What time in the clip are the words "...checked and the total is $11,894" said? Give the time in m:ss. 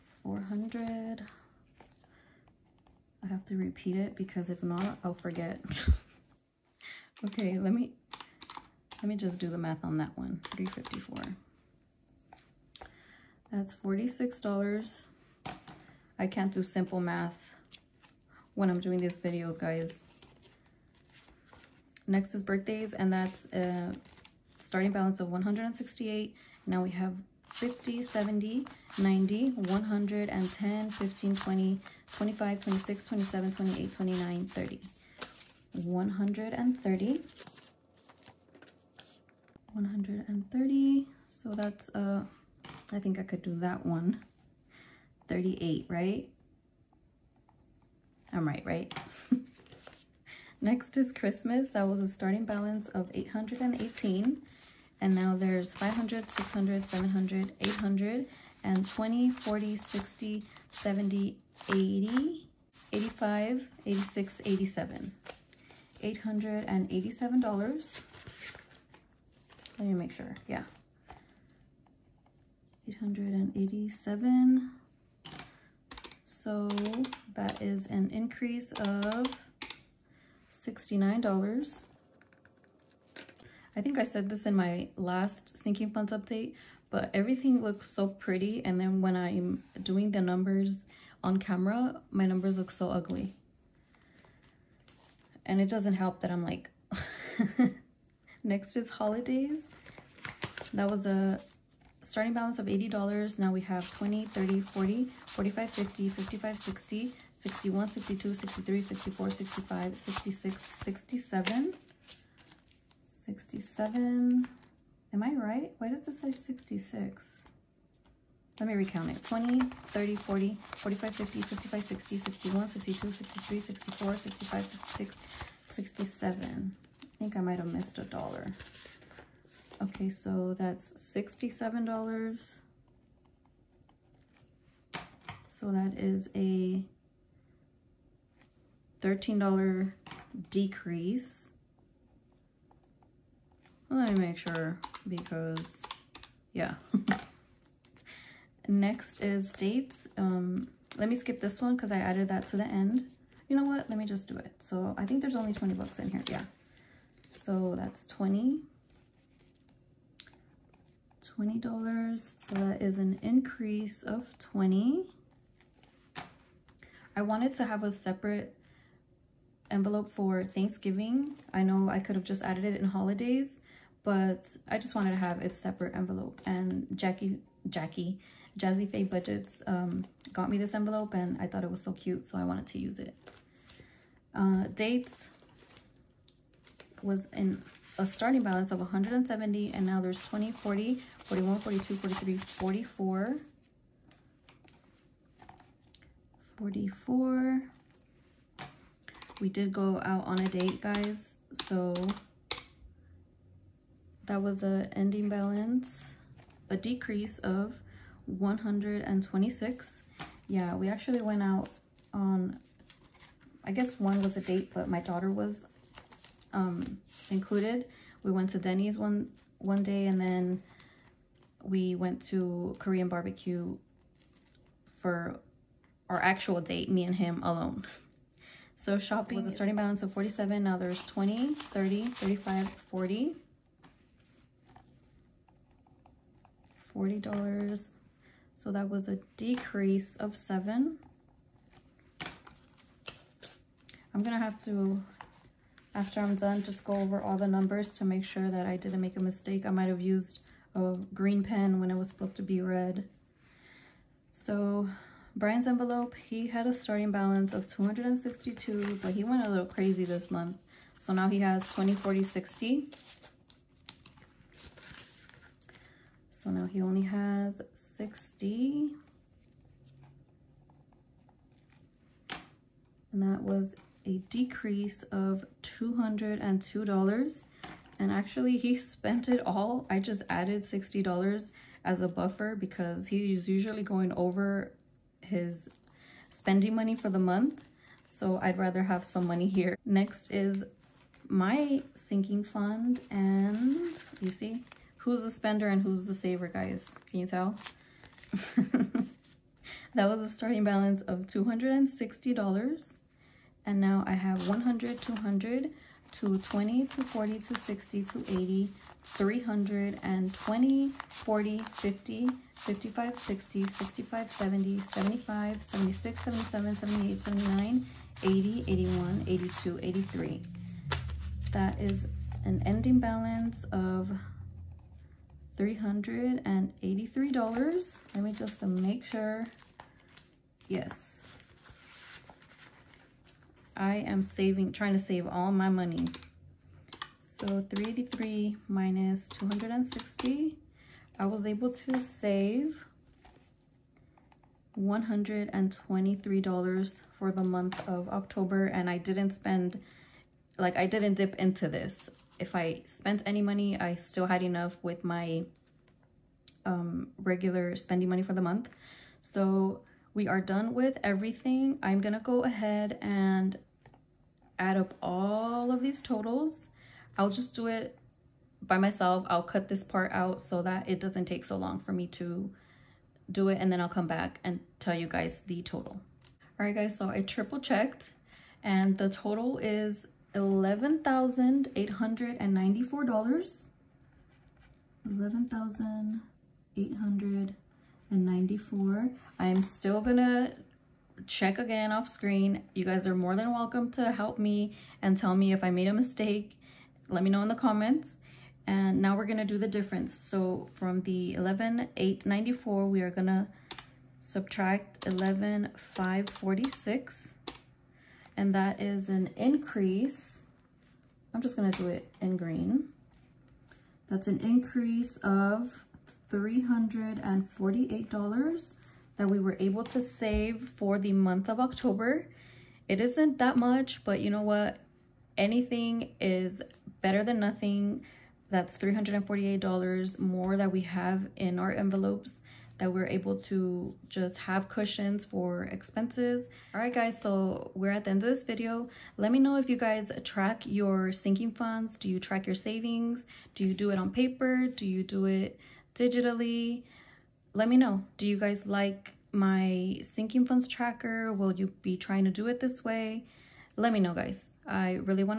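6:17.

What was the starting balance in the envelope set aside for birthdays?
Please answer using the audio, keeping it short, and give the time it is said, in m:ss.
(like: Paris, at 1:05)
$168, at 0:25.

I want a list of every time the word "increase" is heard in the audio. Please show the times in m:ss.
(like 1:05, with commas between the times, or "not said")
2:43, 6:49, 6:54.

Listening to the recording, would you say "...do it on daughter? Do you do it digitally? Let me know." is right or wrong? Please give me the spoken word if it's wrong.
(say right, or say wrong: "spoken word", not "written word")
wrong: "paper", not "daughter".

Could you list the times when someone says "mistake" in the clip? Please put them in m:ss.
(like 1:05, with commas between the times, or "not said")
4:09, 6:35.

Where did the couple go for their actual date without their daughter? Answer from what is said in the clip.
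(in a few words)
Korean barbecue.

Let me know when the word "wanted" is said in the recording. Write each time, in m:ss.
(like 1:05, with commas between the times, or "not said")
2:47, 2:54, 3:02.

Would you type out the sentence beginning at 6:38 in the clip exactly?
And now we're gonna do the difference.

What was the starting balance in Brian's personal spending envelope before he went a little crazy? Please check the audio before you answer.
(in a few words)
$262.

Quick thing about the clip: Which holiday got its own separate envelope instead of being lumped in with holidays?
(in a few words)
Thanksgiving.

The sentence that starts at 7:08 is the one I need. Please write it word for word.
That's $348 more that we have in our envelopes that we're able to just have cushions for expenses.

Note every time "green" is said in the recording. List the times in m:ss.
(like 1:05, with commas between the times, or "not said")
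4:11, 6:52.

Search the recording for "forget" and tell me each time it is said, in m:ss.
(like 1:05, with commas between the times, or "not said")
0:05.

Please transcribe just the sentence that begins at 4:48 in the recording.
So I'd rather have some money here.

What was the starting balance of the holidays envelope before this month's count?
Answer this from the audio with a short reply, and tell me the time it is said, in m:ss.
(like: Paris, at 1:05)
$80, at 1:42.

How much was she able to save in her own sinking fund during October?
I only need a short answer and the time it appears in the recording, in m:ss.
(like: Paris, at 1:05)
$123, at 5:44.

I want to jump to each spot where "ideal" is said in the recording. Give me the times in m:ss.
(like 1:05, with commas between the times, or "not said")
not said.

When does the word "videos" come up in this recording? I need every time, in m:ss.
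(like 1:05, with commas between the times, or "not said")
0:19, 7:18.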